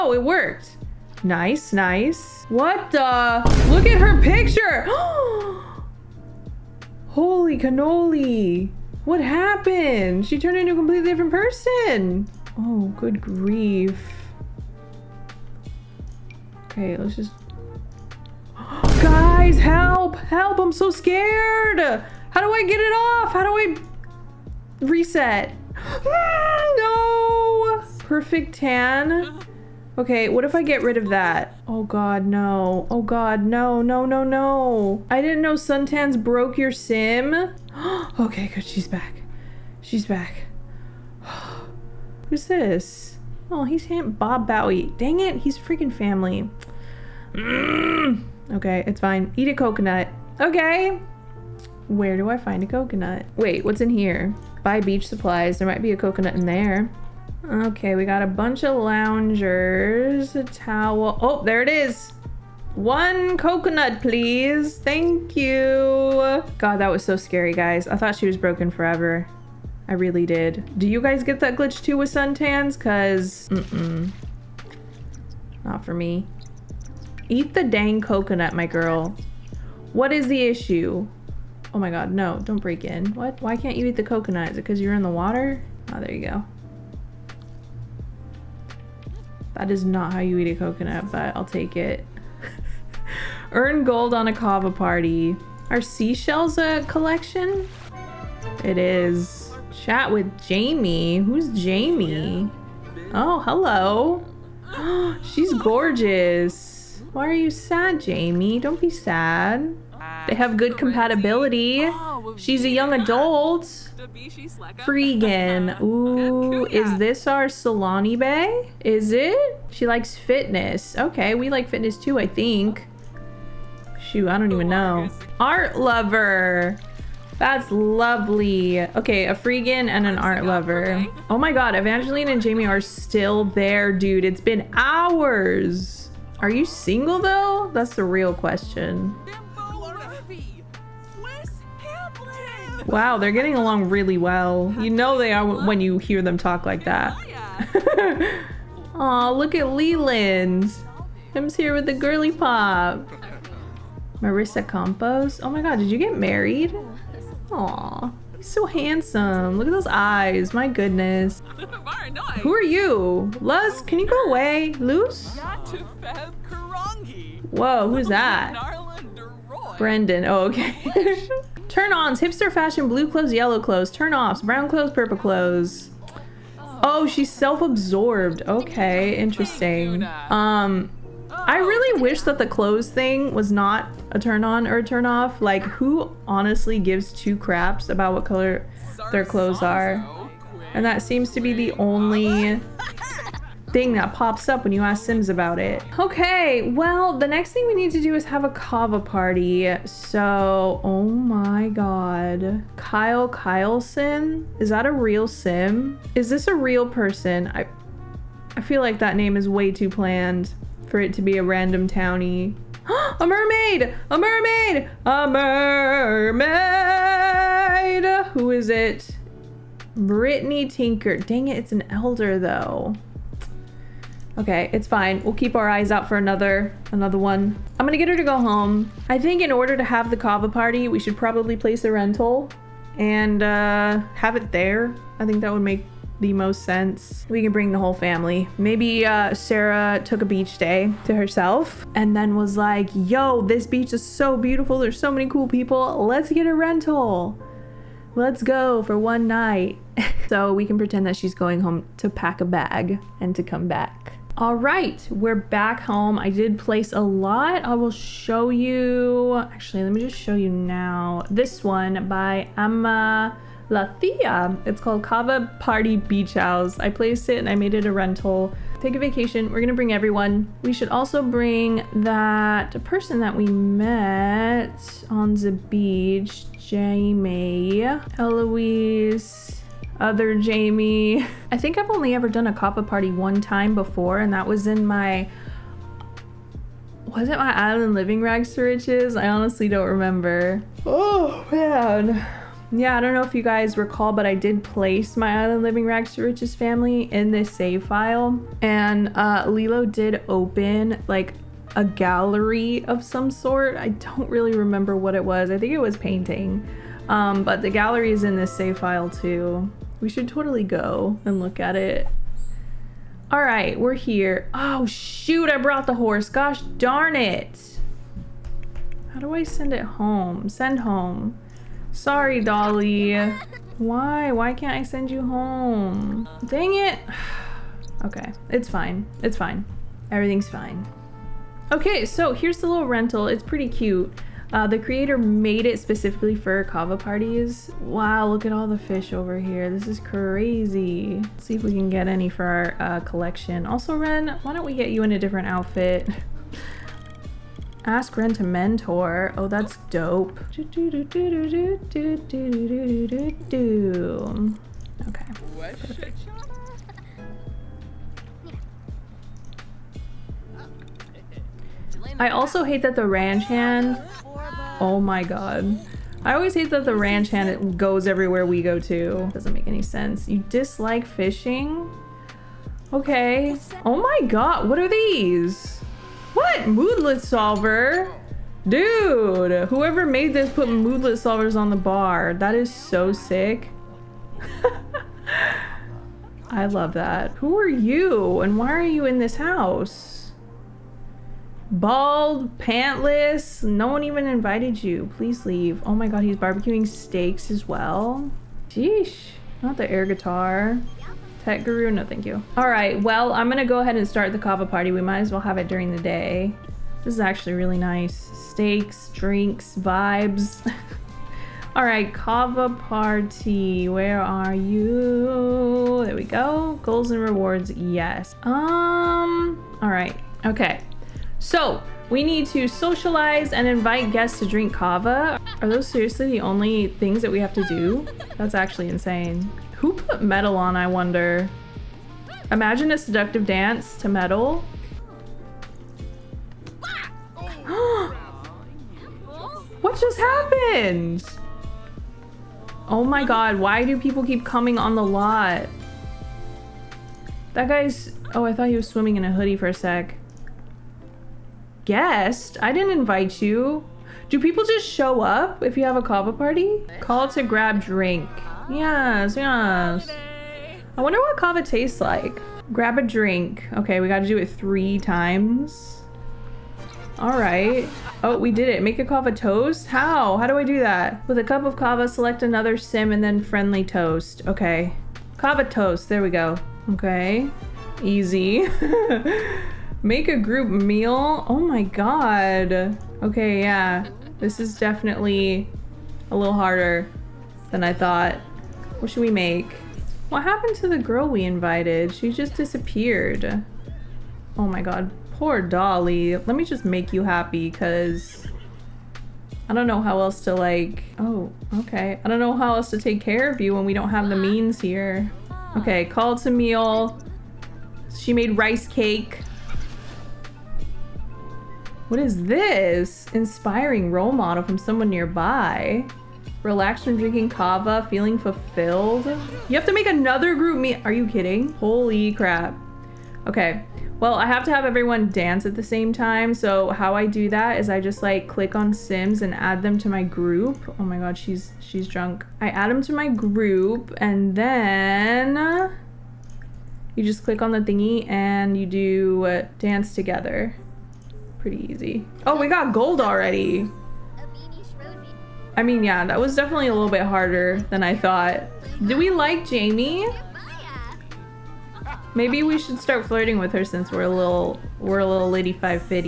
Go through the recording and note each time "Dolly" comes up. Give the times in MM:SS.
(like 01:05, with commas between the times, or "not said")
05:22, 08:15.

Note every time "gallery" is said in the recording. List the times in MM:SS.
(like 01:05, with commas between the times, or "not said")
05:01, 05:07.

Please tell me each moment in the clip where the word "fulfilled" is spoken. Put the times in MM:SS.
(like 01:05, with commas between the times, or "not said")
08:38.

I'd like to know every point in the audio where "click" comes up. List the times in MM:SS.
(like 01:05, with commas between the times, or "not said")
08:48, 08:57.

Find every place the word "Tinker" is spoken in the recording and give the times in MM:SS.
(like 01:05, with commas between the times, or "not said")
03:40.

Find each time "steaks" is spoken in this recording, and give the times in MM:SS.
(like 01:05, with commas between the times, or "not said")
06:36, 06:48.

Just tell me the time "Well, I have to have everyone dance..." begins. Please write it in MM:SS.
08:44.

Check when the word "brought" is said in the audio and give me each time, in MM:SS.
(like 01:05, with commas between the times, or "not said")
05:15.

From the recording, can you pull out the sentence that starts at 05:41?
Let's see if we can get any for our uh, collection.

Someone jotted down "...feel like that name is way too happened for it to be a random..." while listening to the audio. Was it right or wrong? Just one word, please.
wrong.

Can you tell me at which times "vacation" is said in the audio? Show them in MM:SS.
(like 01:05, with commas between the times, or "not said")
04:28.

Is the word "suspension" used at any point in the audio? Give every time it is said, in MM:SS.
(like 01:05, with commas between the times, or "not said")
not said.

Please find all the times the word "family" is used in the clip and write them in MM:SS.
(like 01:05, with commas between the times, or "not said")
00:45, 03:57, 04:56.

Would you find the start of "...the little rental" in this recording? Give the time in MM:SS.
05:32.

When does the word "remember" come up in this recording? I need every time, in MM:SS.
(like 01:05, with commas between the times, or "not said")
04:49, 05:04.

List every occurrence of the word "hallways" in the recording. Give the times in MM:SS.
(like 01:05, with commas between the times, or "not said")
not said.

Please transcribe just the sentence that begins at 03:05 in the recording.
Like, who honestly gives two craps about what color their clothes are?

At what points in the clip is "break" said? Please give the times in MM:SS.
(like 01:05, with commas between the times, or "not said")
01:22.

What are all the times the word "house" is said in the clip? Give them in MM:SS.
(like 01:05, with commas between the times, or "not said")
04:26, 06:29.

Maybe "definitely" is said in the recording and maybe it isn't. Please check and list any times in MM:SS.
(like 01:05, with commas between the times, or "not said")
08:04, 09:06.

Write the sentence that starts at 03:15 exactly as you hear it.
Okay, well, the next thing we need to do is have a kava party.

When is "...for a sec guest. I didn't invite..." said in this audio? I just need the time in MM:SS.
07:29.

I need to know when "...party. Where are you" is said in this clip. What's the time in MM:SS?
06:52.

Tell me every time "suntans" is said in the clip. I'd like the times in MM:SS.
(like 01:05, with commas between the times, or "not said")
00:35, 01:12.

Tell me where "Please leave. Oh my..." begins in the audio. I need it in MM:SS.
06:35.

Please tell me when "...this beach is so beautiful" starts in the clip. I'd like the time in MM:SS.
04:03.